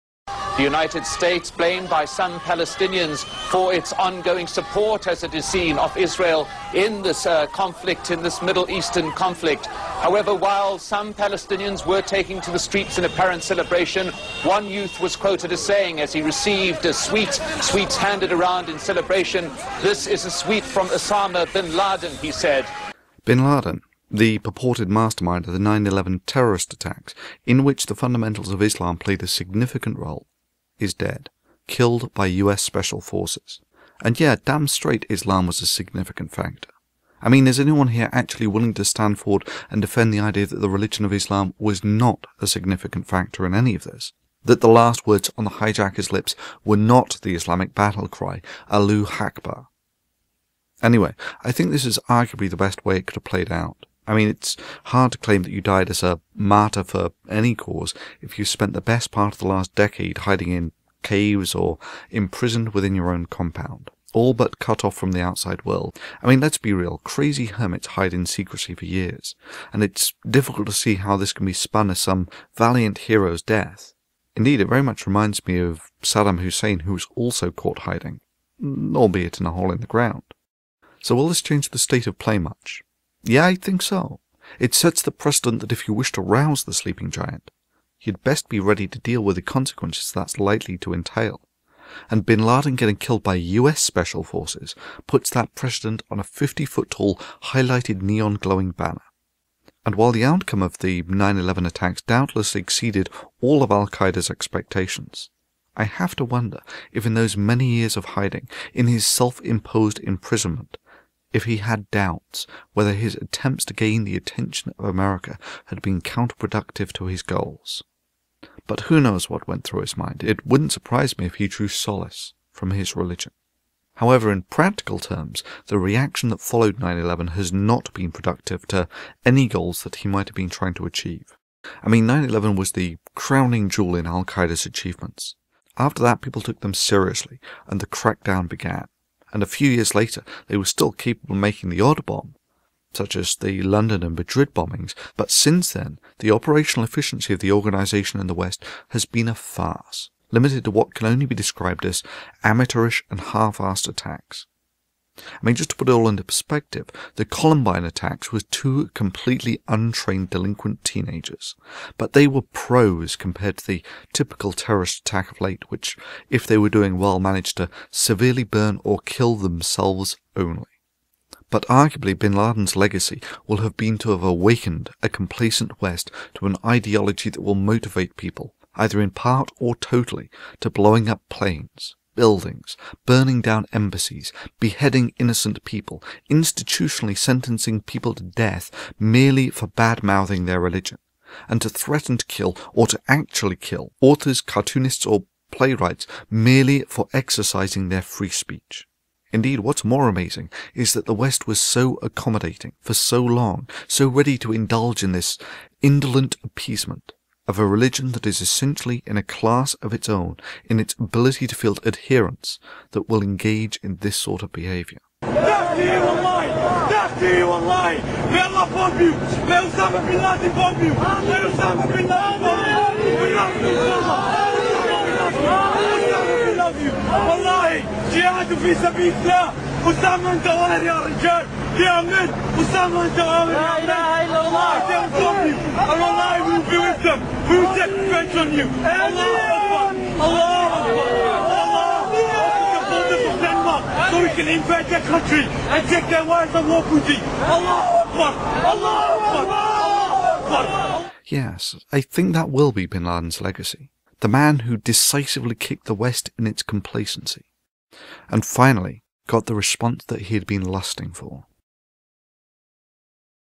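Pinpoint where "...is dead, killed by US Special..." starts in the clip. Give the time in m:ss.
0:30.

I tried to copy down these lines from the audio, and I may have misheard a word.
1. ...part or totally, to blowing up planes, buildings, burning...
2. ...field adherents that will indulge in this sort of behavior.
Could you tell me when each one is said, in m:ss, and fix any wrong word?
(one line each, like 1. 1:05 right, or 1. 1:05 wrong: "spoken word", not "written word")
1. 2:59 right
2. 3:31 wrong: "engage", not "indulge".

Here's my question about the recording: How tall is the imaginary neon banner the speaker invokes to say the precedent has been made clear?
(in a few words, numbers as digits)
50 feet.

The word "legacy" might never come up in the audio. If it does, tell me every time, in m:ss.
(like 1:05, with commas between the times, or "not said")
2:52, 4:13.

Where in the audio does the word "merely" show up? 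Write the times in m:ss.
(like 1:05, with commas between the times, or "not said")
3:08, 3:16.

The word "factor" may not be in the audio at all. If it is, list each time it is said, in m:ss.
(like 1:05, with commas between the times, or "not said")
0:36, 0:43.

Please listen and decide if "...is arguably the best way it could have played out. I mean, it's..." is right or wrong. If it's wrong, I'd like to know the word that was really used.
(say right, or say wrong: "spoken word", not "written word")
right.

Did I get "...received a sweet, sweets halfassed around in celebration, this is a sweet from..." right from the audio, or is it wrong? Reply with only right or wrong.
wrong.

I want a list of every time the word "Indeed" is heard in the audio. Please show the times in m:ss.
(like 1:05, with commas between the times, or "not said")
1:14, 3:19.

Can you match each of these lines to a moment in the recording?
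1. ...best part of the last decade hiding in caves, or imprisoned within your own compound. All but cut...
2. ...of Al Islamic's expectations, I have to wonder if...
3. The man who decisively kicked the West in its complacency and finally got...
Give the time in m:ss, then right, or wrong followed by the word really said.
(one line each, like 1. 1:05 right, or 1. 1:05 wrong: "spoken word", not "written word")
1. 0:58 right
2. 1:43 wrong: "Qaeda", not "Islamic"
3. 4:14 right.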